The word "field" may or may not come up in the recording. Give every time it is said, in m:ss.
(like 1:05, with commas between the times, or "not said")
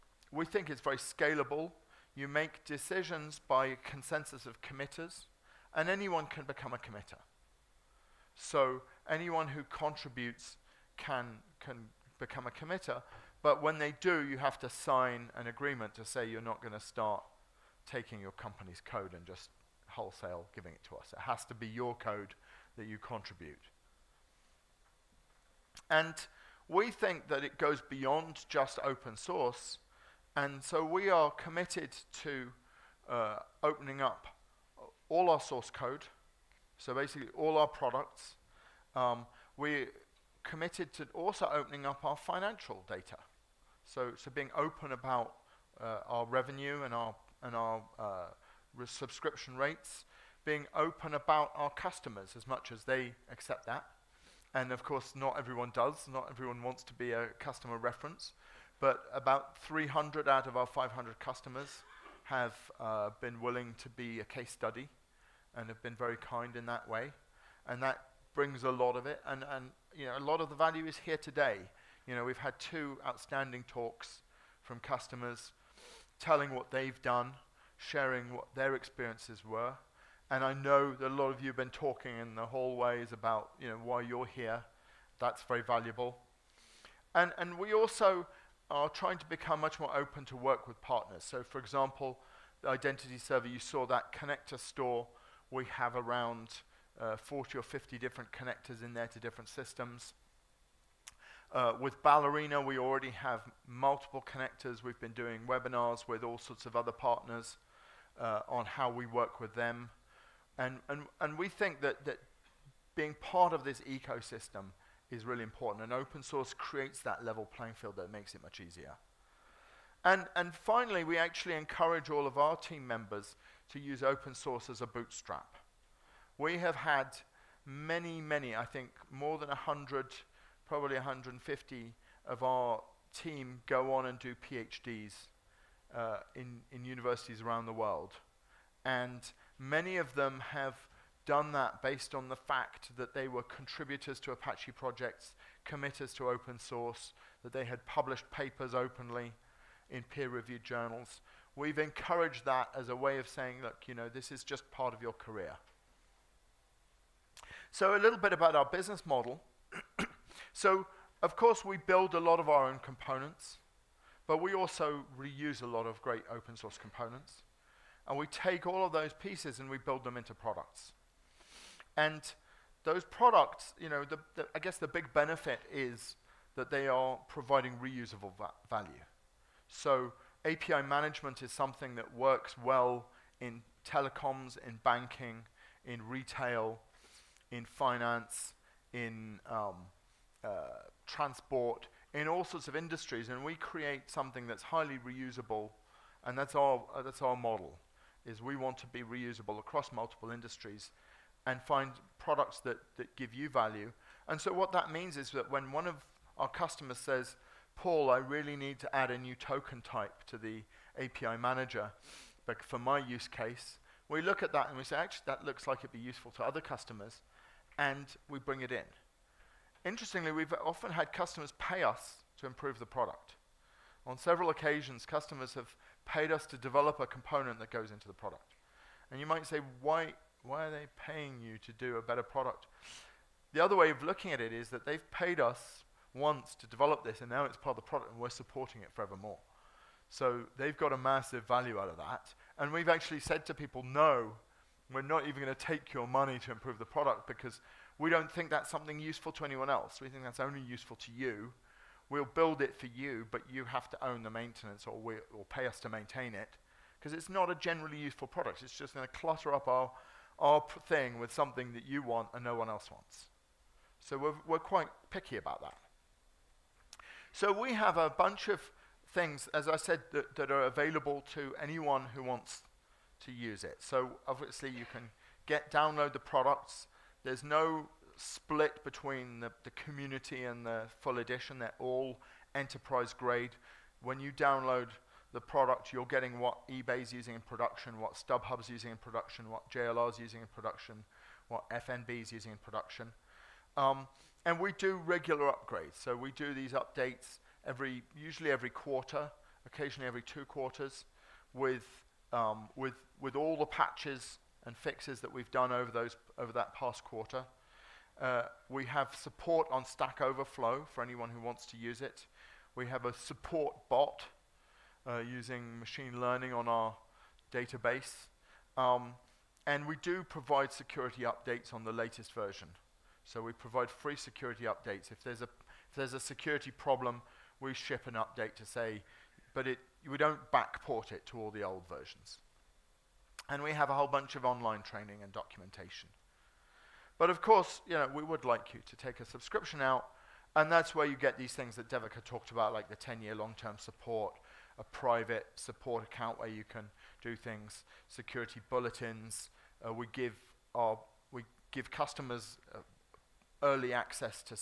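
1:57.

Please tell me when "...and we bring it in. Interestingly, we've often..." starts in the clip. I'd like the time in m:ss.
3:37.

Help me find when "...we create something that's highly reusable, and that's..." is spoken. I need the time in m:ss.
3:13.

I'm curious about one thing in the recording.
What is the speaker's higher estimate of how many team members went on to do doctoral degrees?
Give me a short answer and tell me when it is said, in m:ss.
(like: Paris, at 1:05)
150, at 2:10.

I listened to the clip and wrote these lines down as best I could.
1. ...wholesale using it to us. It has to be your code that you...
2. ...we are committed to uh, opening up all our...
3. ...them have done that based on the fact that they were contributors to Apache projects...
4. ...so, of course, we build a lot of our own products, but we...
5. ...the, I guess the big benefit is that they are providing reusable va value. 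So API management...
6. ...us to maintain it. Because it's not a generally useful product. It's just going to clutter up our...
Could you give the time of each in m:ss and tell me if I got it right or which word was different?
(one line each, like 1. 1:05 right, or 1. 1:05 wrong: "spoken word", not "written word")
1. 0:19 wrong: "giving", not "using"
2. 0:30 right
3. 2:20 right
4. 2:40 wrong: "components", not "products"
5. 2:54 right
6. 4:15 right.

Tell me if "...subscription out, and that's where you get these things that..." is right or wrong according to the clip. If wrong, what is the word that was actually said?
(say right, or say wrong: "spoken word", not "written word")
right.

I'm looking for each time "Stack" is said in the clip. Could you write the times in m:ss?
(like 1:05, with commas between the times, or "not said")
5:09.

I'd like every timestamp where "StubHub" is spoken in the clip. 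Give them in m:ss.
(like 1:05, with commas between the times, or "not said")
4:48.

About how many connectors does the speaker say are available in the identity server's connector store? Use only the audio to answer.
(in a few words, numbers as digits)
40 or 50.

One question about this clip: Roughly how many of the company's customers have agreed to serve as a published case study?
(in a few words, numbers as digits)
300.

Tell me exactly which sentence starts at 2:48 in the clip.
And we take all of those pieces and we build them into products.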